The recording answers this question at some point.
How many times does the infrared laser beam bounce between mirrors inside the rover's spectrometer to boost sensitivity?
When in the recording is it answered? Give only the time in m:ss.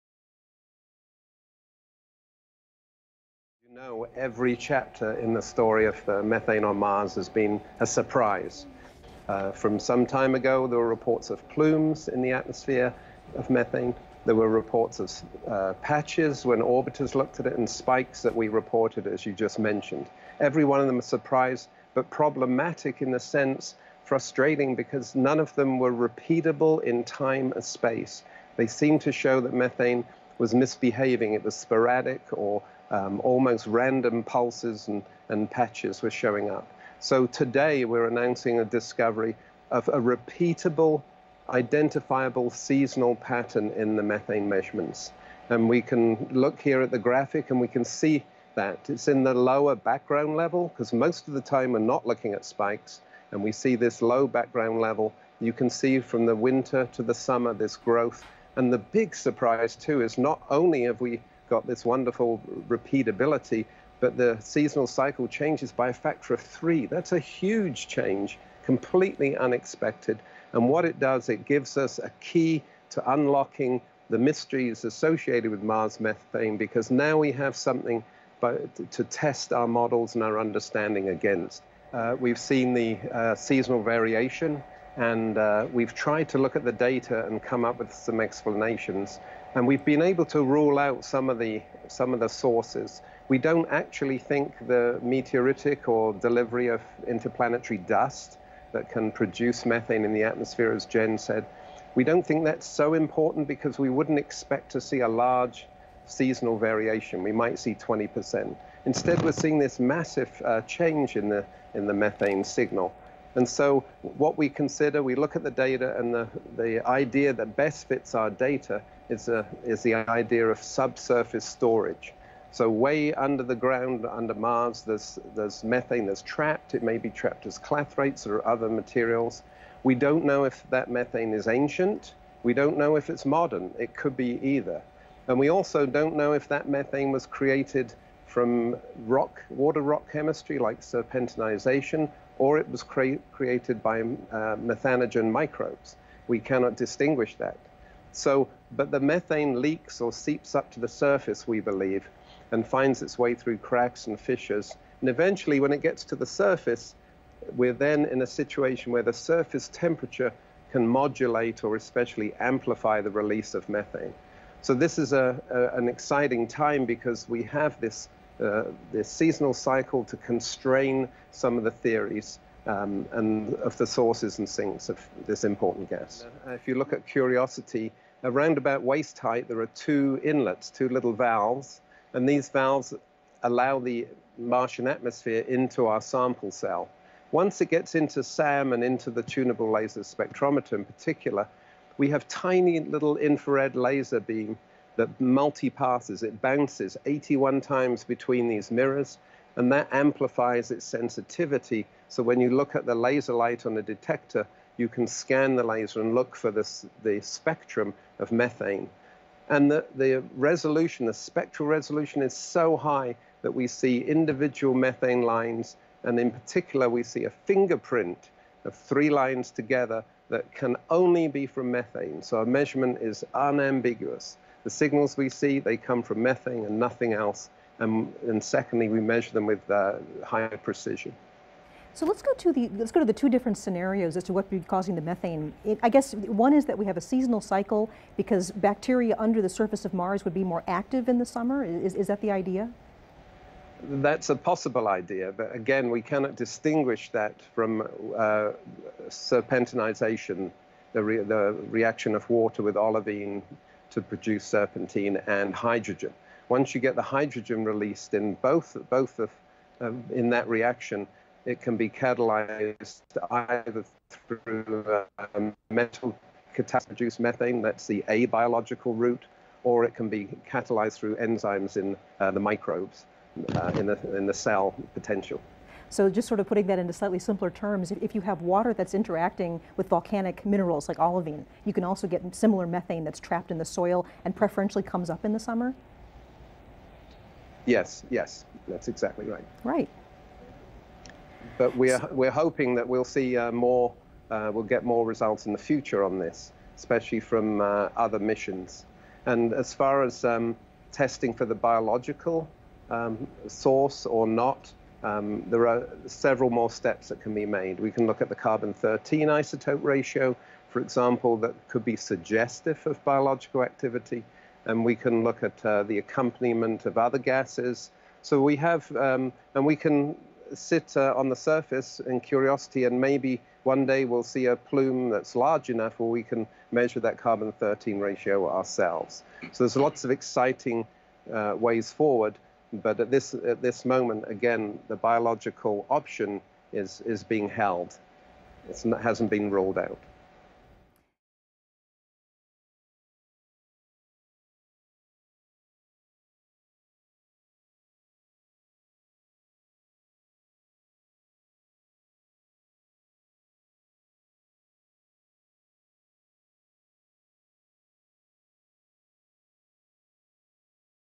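3:17.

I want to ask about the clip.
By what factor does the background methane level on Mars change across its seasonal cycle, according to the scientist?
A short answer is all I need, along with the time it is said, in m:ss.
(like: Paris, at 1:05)
3, at 1:05.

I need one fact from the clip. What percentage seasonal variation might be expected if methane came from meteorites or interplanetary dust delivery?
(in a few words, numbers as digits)
20%.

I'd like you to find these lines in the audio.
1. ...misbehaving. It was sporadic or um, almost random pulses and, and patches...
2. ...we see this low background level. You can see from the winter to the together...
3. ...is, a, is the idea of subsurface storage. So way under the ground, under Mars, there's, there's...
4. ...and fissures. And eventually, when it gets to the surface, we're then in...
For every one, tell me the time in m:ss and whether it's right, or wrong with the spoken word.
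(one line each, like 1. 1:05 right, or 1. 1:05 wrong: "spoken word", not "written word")
1. 0:30 right
2. 0:53 wrong: "summer", not "together"
3. 1:59 right
4. 2:34 right.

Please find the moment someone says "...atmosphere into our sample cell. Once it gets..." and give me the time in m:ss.
3:04.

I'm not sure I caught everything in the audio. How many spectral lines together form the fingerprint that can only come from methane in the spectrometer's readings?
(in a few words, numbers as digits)
3.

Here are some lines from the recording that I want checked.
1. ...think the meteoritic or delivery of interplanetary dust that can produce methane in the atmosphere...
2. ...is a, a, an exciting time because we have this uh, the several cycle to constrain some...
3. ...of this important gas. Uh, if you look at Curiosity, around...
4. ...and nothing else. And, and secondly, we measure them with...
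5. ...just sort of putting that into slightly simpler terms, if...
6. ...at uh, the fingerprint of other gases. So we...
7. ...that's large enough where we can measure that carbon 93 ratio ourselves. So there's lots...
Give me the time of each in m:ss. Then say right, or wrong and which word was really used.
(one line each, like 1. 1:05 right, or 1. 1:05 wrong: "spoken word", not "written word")
1. 1:34 right
2. 2:44 wrong: "seasonal", not "several"
3. 2:54 right
4. 3:46 right
5. 4:36 right
6. 5:15 wrong: "accompaniment", not "fingerprint"
7. 5:25 wrong: "13", not "93".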